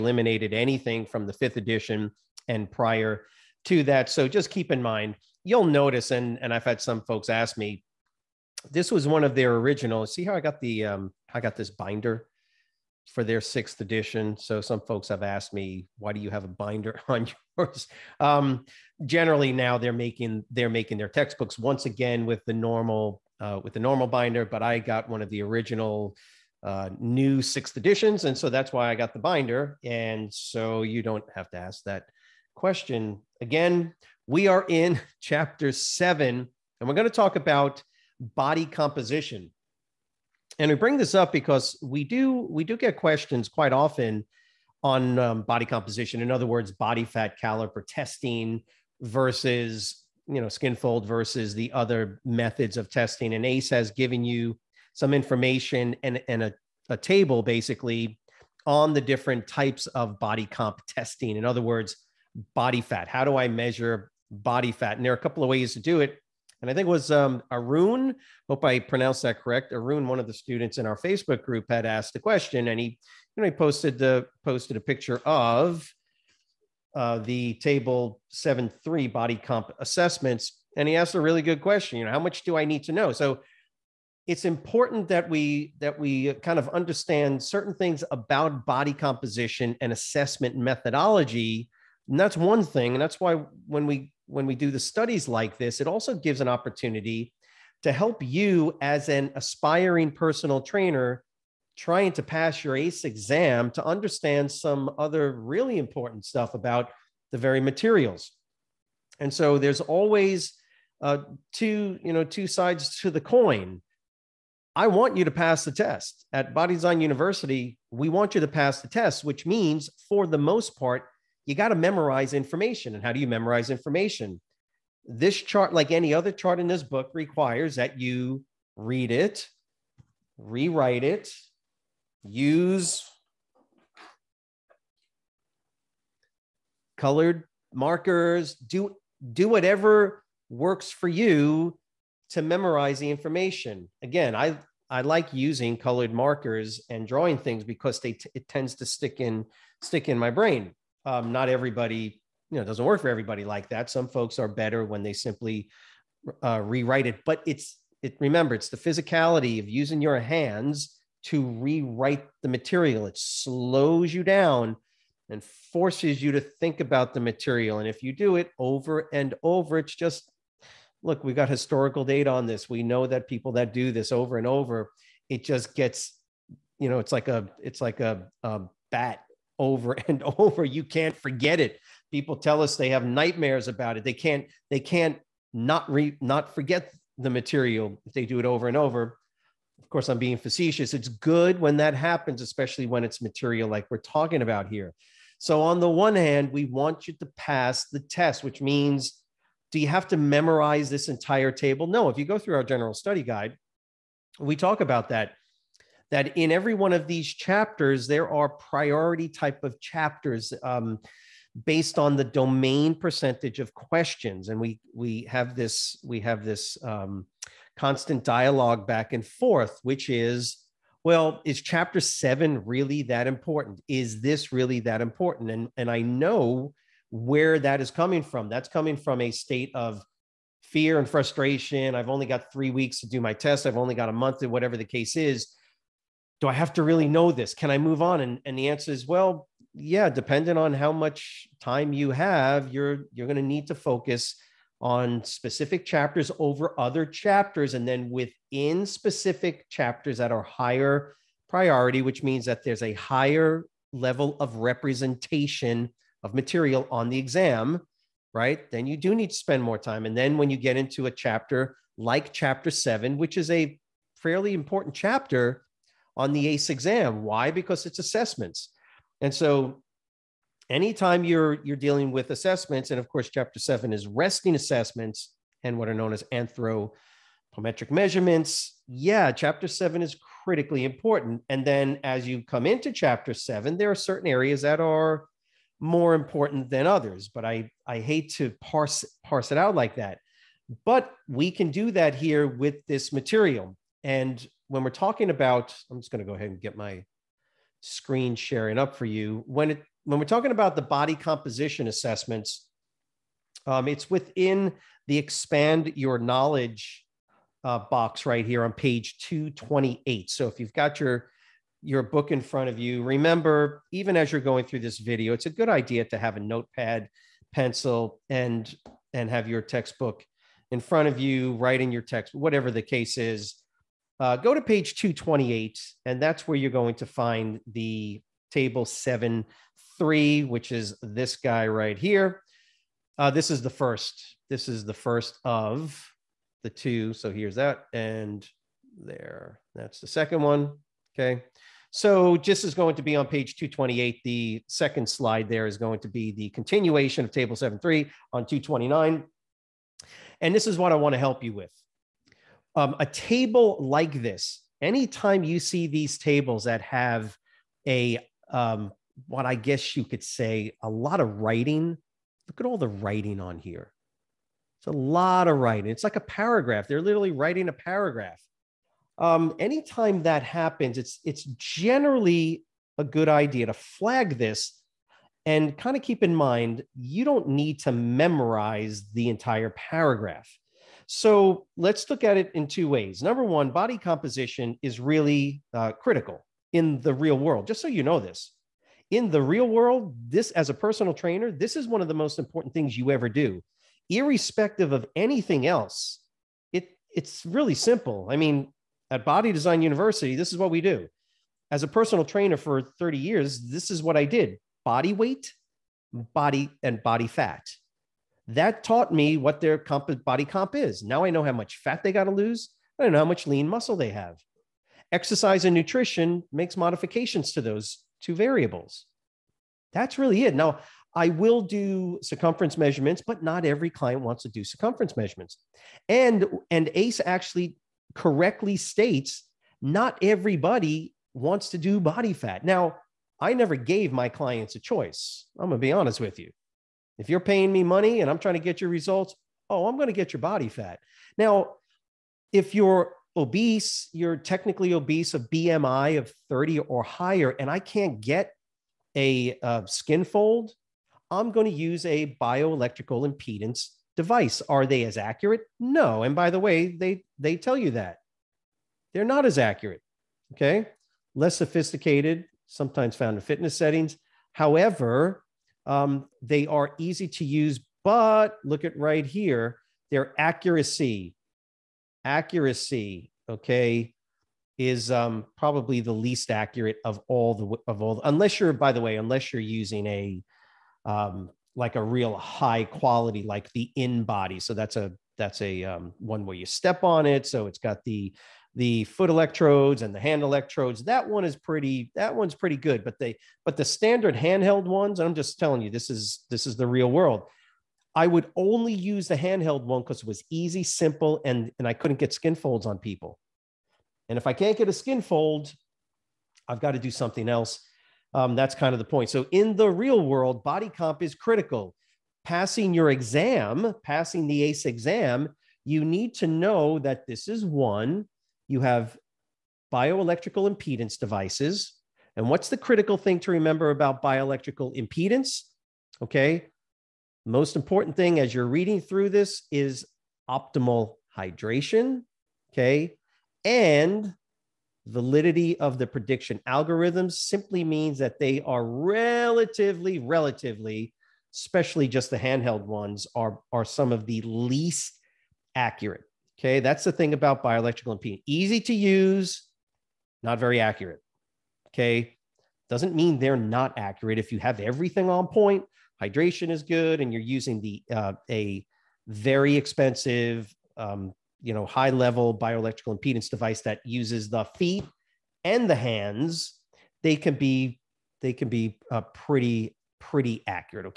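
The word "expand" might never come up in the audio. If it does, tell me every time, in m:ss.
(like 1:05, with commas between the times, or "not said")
5:05.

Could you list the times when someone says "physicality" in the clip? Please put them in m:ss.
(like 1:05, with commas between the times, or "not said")
2:38.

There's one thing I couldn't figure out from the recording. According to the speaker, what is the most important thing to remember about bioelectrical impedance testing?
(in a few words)
optimal hydration.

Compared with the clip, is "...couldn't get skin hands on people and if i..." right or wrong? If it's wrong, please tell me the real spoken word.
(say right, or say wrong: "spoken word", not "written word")
wrong: "folds", not "hands".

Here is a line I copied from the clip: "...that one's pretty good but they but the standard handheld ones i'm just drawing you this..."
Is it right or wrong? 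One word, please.
wrong.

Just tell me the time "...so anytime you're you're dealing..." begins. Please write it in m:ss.
4:29.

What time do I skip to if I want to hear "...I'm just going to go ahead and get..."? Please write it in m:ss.
4:55.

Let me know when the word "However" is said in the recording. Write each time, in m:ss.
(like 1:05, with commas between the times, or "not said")
7:44.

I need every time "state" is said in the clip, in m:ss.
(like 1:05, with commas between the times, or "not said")
3:49, 7:08.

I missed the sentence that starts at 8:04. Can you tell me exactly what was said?
So that's a that's a um, one where you step on it.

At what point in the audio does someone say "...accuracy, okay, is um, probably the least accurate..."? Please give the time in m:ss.
7:52.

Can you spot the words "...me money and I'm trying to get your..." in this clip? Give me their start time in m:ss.
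7:17.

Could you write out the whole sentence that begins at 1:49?
And so there's always uh, two, you know, two sides to the coin.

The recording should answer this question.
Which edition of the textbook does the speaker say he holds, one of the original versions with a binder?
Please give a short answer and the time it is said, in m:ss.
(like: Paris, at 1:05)
sixth edition, at 0:13.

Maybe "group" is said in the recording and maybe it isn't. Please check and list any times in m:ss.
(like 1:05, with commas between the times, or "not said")
1:11.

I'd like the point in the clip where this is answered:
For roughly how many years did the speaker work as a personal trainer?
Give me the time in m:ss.
6:42.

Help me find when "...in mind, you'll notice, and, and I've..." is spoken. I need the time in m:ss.
0:04.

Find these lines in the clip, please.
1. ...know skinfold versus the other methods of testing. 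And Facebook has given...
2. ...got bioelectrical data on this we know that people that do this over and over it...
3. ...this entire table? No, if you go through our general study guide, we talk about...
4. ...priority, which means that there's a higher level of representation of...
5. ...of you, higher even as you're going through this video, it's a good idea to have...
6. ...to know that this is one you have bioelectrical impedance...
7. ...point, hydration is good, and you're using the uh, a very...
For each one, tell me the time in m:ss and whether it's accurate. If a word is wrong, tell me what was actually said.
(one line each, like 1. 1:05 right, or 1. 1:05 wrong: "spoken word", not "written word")
1. 0:50 wrong: "ACE", not "Facebook"
2. 2:51 wrong: "historical", not "bioelectrical"
3. 3:20 right
4. 4:11 right
5. 5:12 wrong: "remember", not "higher"
6. 8:36 right
7. 9:15 right.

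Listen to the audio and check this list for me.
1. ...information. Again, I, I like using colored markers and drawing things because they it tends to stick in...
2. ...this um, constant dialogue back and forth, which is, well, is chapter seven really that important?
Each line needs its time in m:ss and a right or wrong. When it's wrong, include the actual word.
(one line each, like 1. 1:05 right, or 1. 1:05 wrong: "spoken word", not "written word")
1. 2:23 right
2. 3:36 right.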